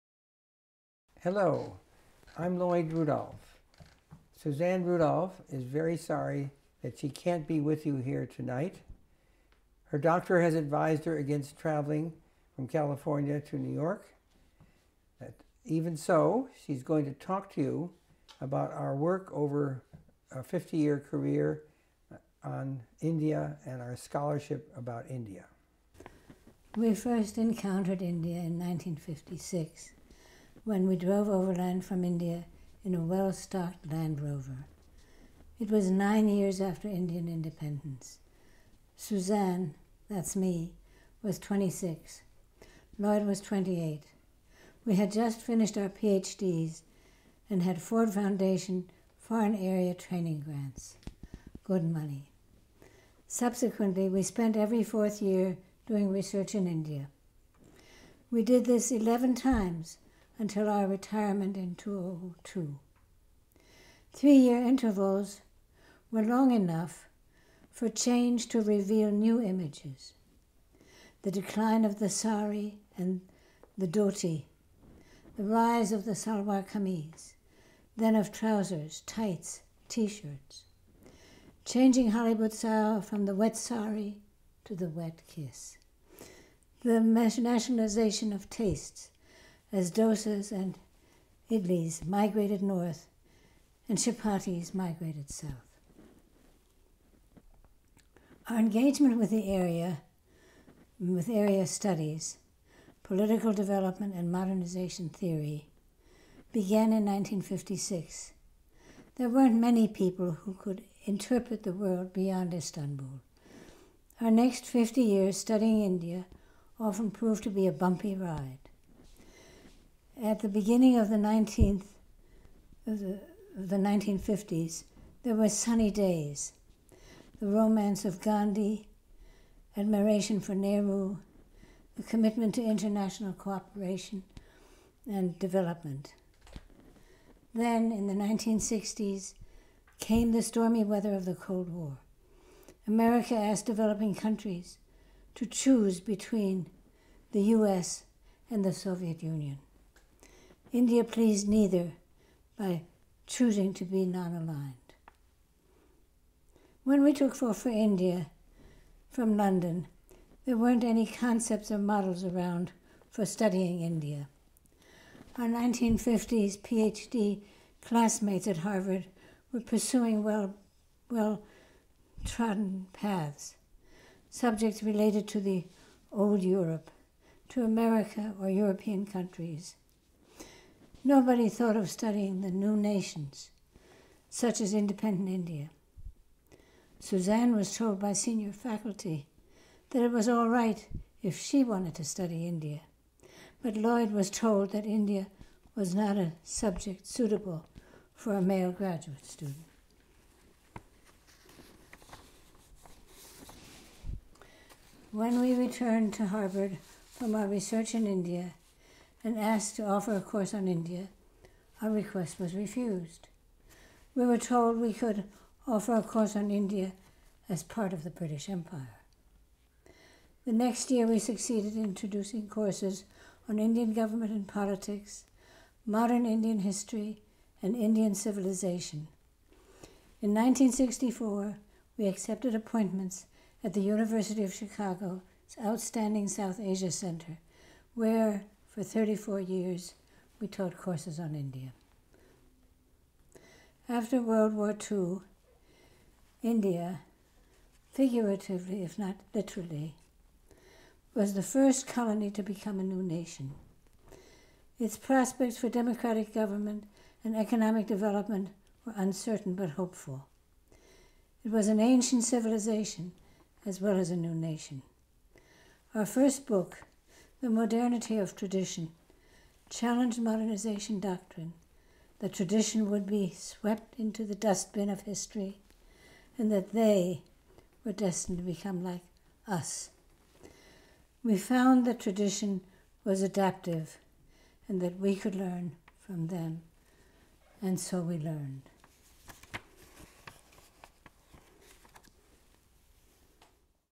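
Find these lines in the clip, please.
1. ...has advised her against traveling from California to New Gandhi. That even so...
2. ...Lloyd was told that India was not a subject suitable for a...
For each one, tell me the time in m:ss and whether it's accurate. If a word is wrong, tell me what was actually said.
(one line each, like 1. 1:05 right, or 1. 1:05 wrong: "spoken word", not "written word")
1. 0:10 wrong: "York", not "Gandhi"
2. 3:13 right.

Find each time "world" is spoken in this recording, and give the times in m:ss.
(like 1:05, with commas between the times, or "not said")
1:51, 4:04.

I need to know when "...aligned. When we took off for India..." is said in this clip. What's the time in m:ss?
2:34.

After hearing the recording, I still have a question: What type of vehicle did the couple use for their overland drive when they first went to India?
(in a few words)
Land Rover.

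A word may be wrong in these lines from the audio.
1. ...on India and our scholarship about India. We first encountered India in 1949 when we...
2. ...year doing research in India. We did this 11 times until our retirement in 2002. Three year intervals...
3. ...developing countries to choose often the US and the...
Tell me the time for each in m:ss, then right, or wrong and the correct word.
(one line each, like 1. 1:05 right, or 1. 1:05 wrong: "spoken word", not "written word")
1. 0:22 wrong: "1956", not "1949"
2. 0:55 right
3. 2:23 wrong: "between", not "often".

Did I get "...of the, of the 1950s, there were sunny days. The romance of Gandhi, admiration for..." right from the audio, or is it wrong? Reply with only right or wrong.
right.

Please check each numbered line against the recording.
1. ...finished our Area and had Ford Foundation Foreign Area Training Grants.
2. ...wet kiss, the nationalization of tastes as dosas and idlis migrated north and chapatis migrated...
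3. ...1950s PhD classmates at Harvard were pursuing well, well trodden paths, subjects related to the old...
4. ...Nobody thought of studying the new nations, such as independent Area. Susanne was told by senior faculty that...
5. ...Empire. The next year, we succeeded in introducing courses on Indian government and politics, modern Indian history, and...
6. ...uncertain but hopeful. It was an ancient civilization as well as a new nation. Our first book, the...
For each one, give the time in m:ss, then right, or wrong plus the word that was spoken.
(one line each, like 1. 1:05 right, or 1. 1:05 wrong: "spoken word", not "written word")
1. 0:45 wrong: "PhDs", not "Area"
2. 1:24 right
3. 2:45 right
4. 3:01 wrong: "India", not "Area"
5. 3:38 right
6. 4:18 right.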